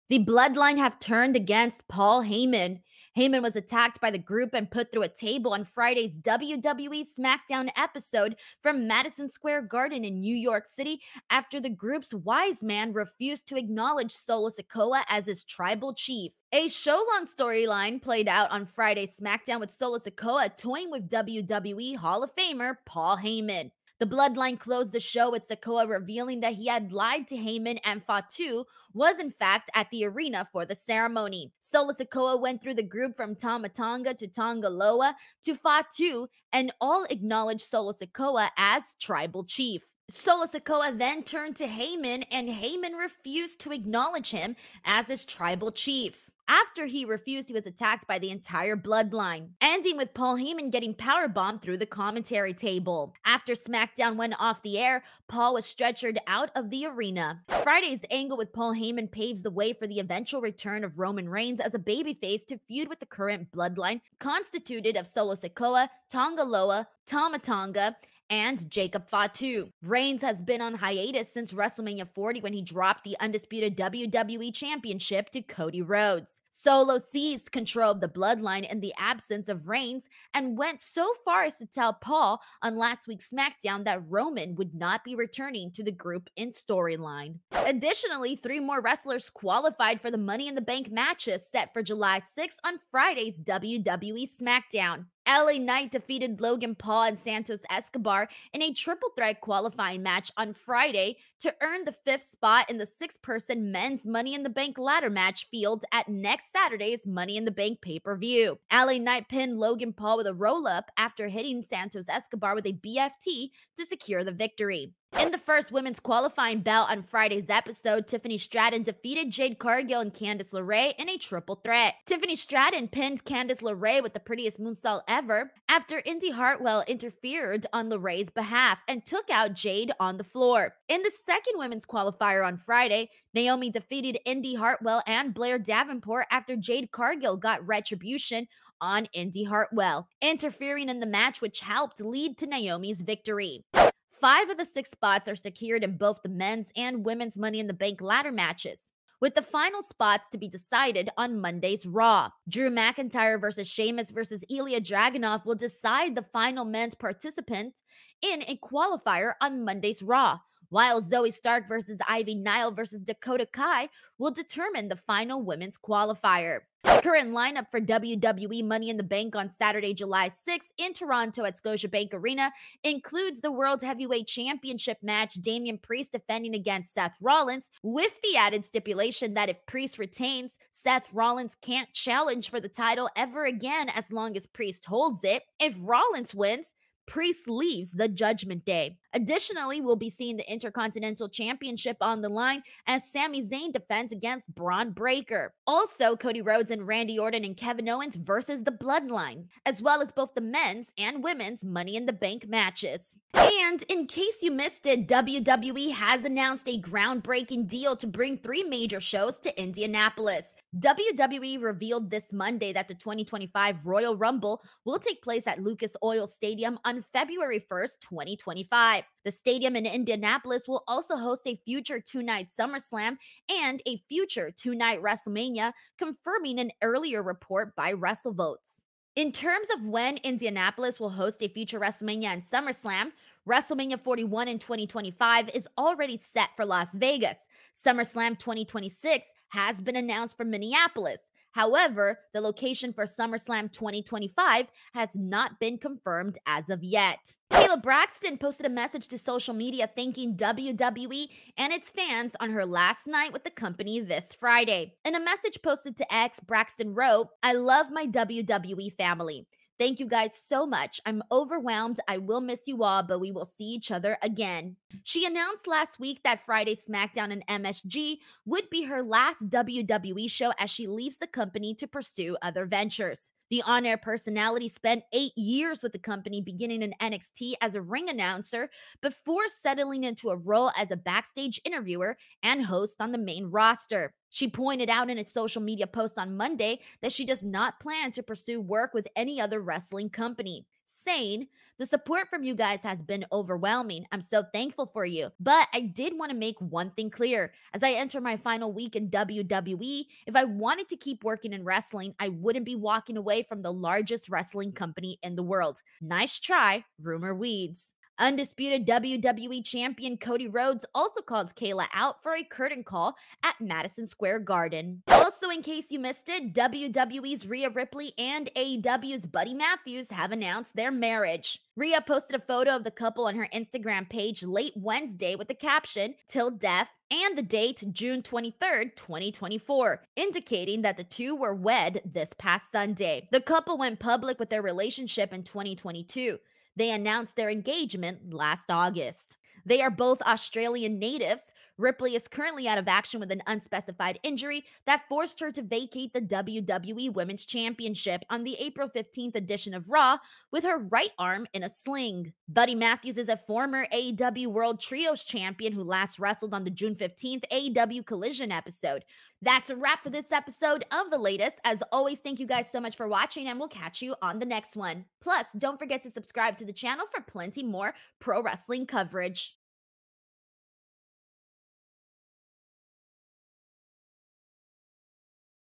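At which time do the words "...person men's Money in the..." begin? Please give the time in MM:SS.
01:43.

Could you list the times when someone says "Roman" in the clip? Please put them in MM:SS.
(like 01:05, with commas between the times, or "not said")
01:00, 01:24.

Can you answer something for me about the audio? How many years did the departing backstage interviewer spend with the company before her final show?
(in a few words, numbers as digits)
8.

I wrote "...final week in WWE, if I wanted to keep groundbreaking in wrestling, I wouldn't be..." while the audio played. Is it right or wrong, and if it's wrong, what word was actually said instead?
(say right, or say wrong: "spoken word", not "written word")
wrong: "working", not "groundbreaking".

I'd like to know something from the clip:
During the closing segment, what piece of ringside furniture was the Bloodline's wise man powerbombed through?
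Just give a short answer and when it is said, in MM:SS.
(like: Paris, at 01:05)
commentary table, at 00:51.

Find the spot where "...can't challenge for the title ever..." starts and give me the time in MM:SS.
03:01.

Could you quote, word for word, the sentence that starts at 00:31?
Solo Sikoa went through the group from Tama Tonga to Tonga Loa to Fatu and all acknowledged Solo Sikoa as tribal chief.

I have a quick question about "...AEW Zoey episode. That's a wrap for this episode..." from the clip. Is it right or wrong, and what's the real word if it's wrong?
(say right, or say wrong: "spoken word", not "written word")
wrong: "Collision", not "Zoey".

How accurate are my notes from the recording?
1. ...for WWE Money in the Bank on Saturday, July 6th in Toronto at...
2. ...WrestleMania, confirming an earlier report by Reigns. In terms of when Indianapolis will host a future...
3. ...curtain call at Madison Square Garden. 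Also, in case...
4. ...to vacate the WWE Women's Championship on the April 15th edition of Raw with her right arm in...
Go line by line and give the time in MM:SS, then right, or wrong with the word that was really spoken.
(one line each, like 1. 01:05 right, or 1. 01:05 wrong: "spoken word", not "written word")
1. 02:47 right
2. 03:45 wrong: "WrestleVotes", not "Reigns"
3. 05:12 right
4. 05:45 right.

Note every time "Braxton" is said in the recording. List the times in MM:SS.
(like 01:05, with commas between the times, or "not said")
04:07, 04:16.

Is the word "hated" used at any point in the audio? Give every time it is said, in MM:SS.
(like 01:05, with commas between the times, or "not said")
not said.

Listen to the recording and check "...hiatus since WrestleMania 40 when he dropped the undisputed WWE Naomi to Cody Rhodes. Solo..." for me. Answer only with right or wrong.
wrong.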